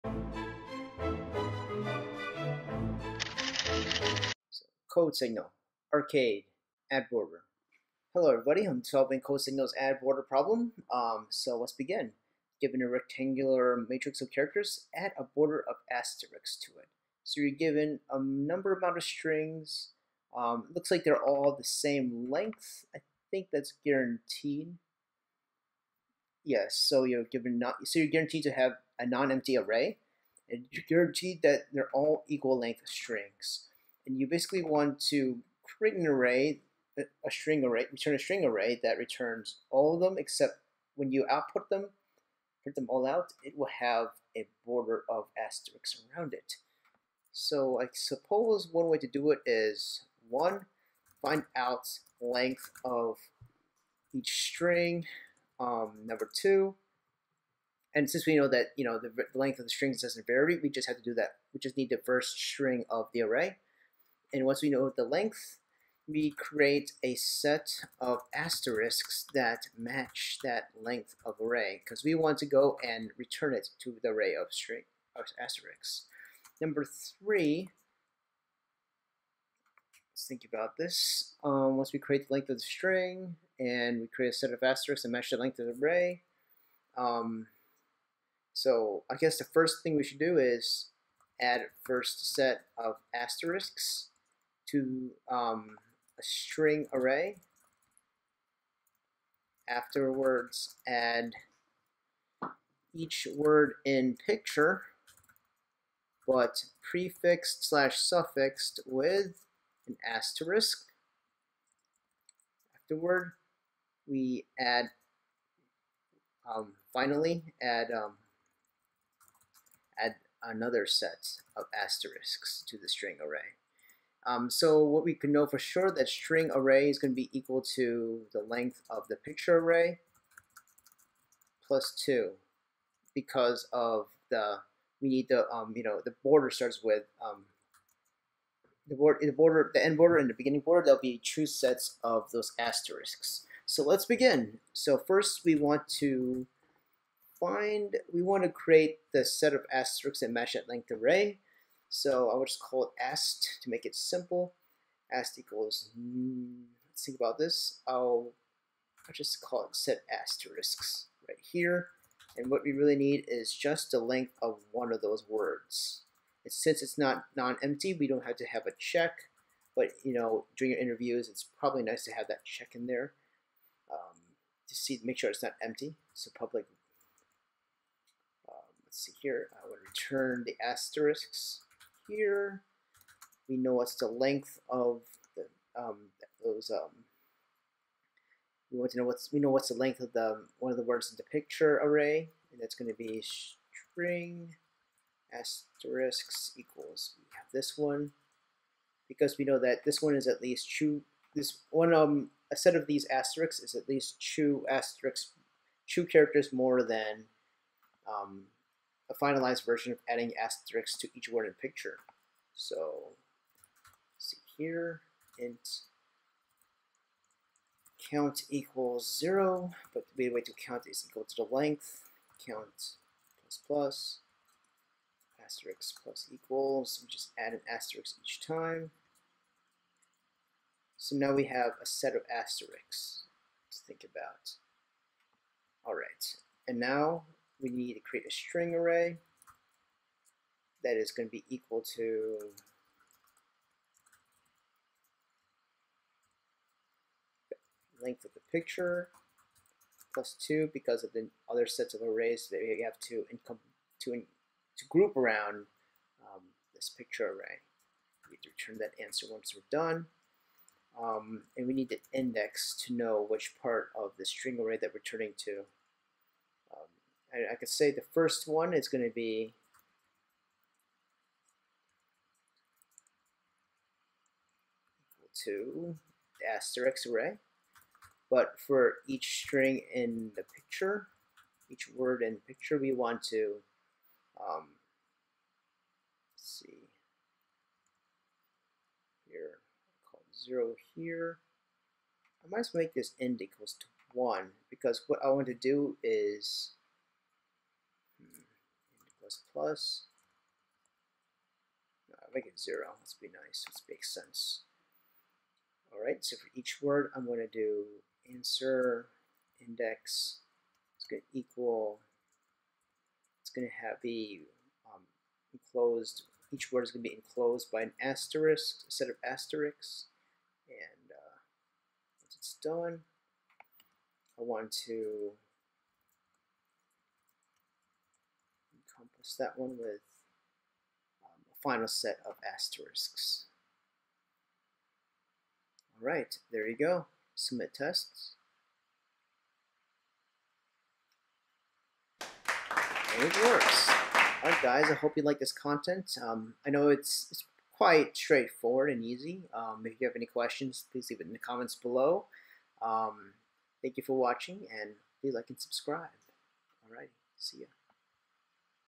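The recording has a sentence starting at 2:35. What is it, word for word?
s equals, let's think about this.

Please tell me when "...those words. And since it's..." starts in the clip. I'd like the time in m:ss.
2:45.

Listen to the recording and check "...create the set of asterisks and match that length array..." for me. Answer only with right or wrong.
right.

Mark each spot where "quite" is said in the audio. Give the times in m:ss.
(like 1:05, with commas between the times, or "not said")
5:47.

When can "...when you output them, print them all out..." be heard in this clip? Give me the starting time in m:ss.
0:40.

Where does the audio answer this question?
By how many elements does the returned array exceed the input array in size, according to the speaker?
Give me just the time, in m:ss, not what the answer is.
2:11.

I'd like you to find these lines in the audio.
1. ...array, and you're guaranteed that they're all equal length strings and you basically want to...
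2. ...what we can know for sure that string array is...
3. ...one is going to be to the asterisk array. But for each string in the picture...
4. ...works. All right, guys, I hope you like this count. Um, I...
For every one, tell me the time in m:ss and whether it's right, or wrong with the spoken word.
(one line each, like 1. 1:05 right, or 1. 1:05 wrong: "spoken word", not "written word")
1. 0:29 right
2. 2:04 right
3. 4:28 right
4. 5:43 wrong: "content", not "count".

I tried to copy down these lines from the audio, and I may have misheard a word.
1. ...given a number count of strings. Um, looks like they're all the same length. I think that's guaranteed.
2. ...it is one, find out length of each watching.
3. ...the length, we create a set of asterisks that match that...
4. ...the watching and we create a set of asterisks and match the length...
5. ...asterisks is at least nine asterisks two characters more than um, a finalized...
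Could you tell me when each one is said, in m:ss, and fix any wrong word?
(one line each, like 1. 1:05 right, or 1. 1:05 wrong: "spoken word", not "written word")
1. 0:17 wrong: "amount", not "count"
2. 0:49 wrong: "string", not "watching"
3. 1:04 right
4. 1:22 wrong: "string", not "watching"
5. 3:23 wrong: "two", not "nine".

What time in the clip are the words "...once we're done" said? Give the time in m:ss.
4:19.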